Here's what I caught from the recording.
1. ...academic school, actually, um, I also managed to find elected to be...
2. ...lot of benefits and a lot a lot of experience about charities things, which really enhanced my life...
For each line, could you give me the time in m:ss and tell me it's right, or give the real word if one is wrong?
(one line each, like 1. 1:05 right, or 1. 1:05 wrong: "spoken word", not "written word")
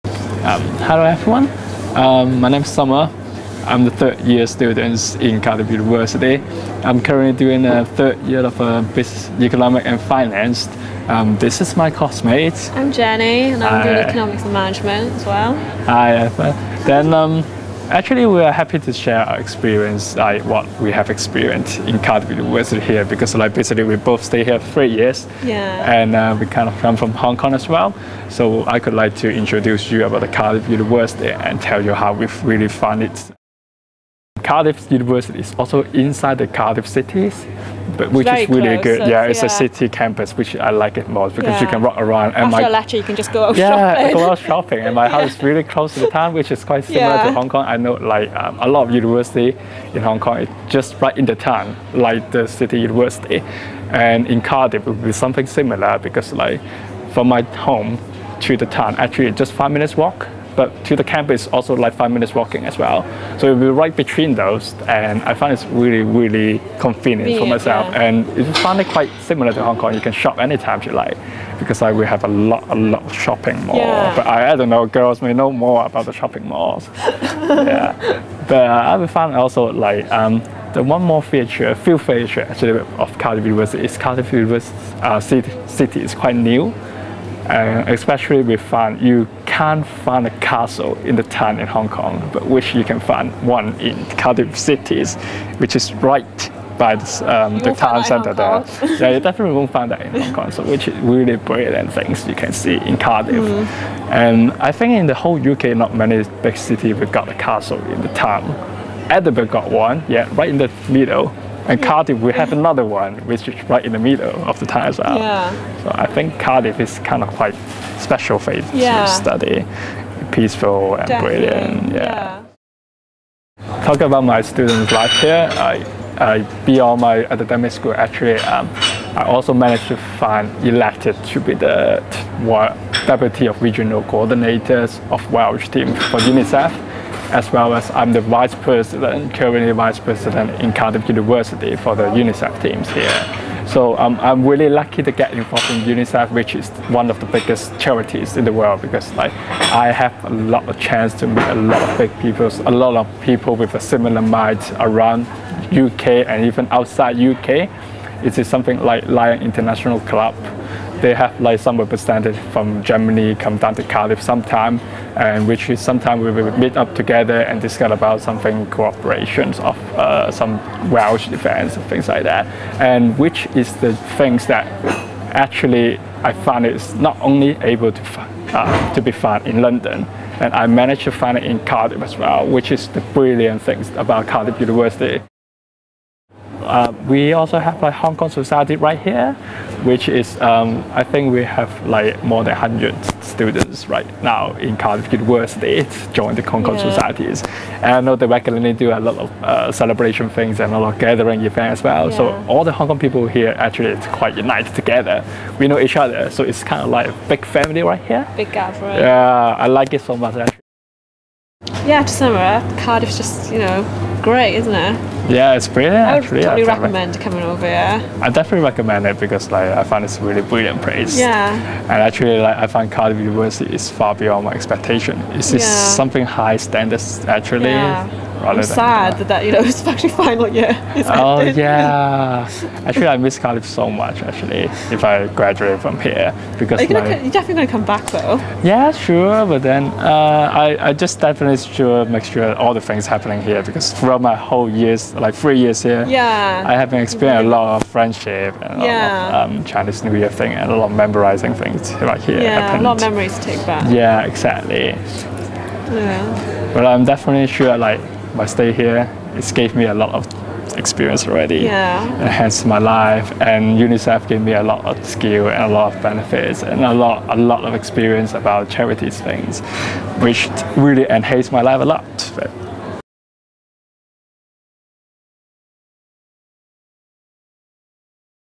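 1. 2:07 right
2. 4:25 right.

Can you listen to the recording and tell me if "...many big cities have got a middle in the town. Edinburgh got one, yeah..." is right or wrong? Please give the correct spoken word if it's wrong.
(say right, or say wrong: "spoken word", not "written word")
wrong: "castle", not "middle".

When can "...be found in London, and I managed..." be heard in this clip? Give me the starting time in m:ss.
2:59.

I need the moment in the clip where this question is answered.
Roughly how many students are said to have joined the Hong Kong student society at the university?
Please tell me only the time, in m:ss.
3:12.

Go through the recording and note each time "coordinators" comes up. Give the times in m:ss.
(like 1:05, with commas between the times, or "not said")
2:14.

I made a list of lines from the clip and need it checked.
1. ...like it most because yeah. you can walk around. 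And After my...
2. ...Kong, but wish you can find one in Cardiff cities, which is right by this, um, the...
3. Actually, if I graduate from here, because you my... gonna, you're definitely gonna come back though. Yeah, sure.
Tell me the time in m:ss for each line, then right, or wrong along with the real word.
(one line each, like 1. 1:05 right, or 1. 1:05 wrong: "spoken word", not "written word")
1. 0:40 right
2. 1:31 right
3. 3:54 right.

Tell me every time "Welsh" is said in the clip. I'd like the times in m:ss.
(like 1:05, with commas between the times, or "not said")
2:15, 2:50.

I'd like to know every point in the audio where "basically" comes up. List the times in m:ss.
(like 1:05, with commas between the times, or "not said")
0:23.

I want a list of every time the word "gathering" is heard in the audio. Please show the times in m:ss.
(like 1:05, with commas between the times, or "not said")
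3:21, 3:28.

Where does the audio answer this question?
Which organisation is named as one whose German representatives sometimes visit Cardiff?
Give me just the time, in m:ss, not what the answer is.
2:39.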